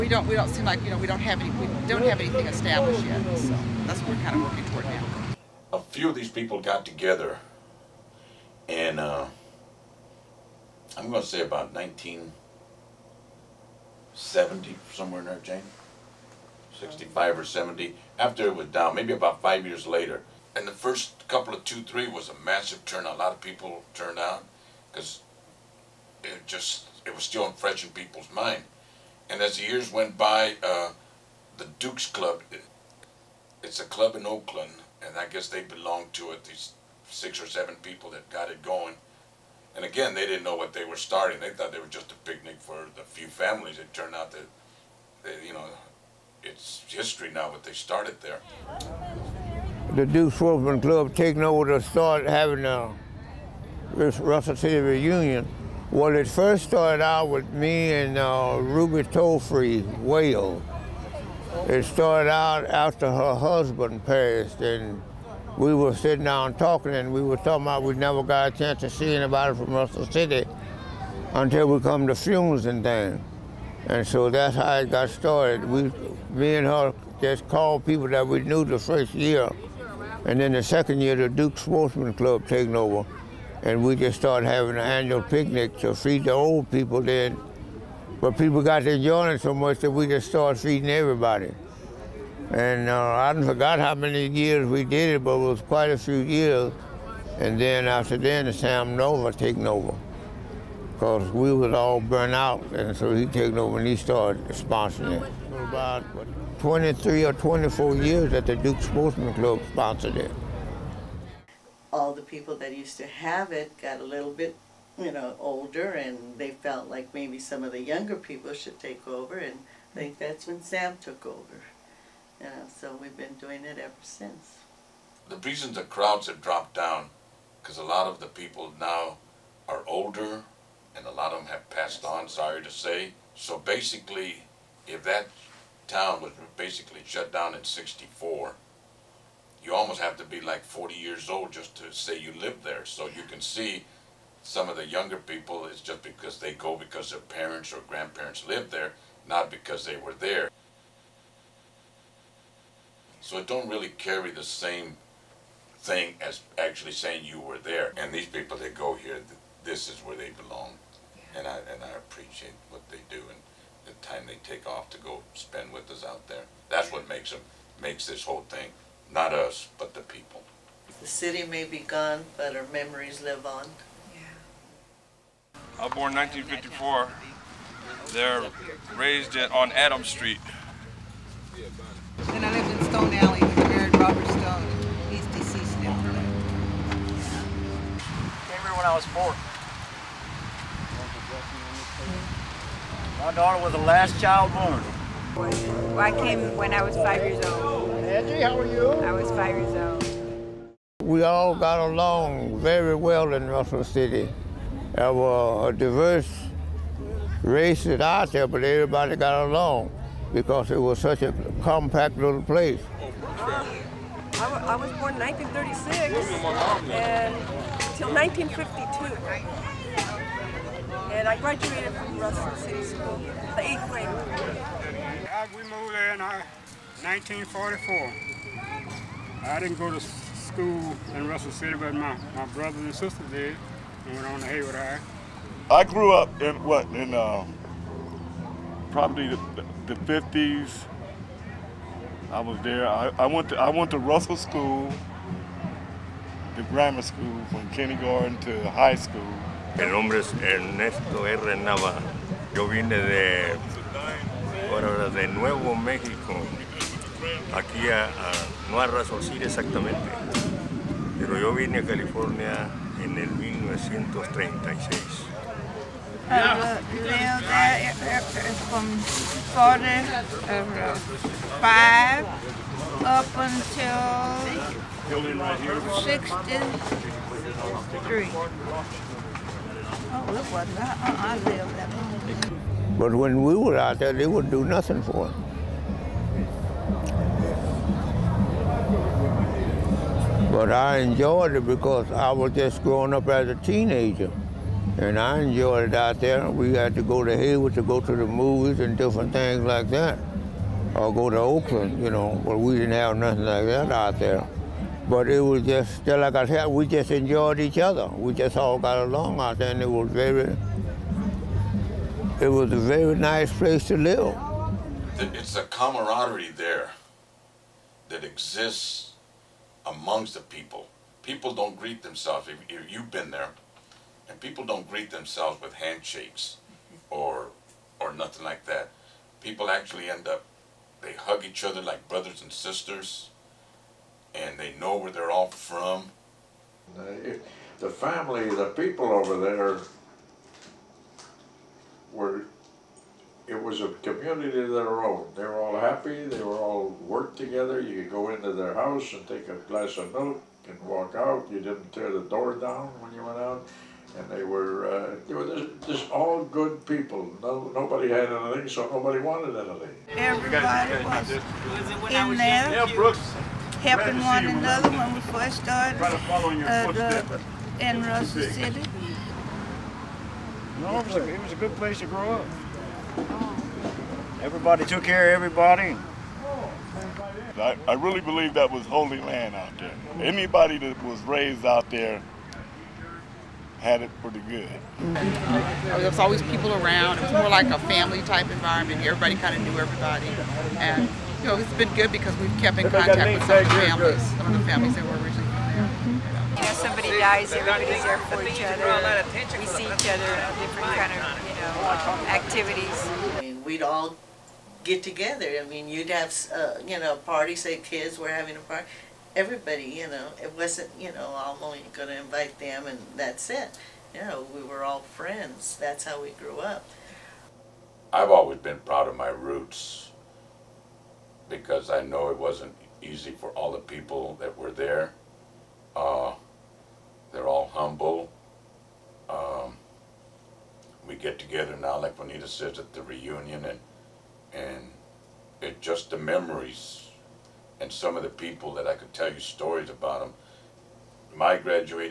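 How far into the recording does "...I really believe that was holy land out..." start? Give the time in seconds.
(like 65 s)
377 s.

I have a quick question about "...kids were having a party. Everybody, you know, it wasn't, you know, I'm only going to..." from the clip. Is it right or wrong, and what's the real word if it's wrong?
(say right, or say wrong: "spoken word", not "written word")
right.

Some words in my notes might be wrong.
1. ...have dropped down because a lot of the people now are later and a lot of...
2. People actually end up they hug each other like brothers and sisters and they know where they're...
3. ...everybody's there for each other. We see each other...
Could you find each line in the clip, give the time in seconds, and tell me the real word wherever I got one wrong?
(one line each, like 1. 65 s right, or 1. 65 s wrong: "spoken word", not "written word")
1. 126 s wrong: "older", not "later"
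2. 329 s right
3. 397 s right.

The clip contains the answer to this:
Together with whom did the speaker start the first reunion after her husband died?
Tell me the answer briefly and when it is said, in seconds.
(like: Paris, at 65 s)
Ruby Tolefree Whale, at 58 s.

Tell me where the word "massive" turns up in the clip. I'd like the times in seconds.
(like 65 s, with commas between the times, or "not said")
22 s.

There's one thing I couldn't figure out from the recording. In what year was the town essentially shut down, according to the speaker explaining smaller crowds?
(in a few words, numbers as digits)
1964.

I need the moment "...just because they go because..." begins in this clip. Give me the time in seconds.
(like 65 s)
145 s.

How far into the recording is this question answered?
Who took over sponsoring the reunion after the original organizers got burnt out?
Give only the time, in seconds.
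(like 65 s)
98 s.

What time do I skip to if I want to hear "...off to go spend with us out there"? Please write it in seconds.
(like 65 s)
164 s.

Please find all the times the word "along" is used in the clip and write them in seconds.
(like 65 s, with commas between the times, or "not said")
201 s, 209 s, 308 s.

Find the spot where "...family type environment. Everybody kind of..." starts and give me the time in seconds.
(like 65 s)
387 s.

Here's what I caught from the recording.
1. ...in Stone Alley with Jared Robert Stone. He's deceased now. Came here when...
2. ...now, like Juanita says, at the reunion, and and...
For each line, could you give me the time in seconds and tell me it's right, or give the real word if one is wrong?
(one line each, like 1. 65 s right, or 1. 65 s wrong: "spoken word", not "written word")
1. 182 s right
2. 431 s right.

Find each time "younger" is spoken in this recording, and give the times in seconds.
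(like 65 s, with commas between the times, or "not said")
117 s, 144 s.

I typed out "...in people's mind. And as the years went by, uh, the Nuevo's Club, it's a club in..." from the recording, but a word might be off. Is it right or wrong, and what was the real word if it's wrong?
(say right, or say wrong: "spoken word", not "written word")
wrong: "Duke", not "Nuevo".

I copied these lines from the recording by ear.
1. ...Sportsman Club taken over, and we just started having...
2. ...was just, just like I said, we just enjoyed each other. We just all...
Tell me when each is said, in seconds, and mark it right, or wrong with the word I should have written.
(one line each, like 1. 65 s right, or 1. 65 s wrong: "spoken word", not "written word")
1. 81 s right
2. 305 s right.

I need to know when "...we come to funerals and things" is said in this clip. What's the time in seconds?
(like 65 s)
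71 s.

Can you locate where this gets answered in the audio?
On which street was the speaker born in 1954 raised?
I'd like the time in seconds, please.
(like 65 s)
179 s.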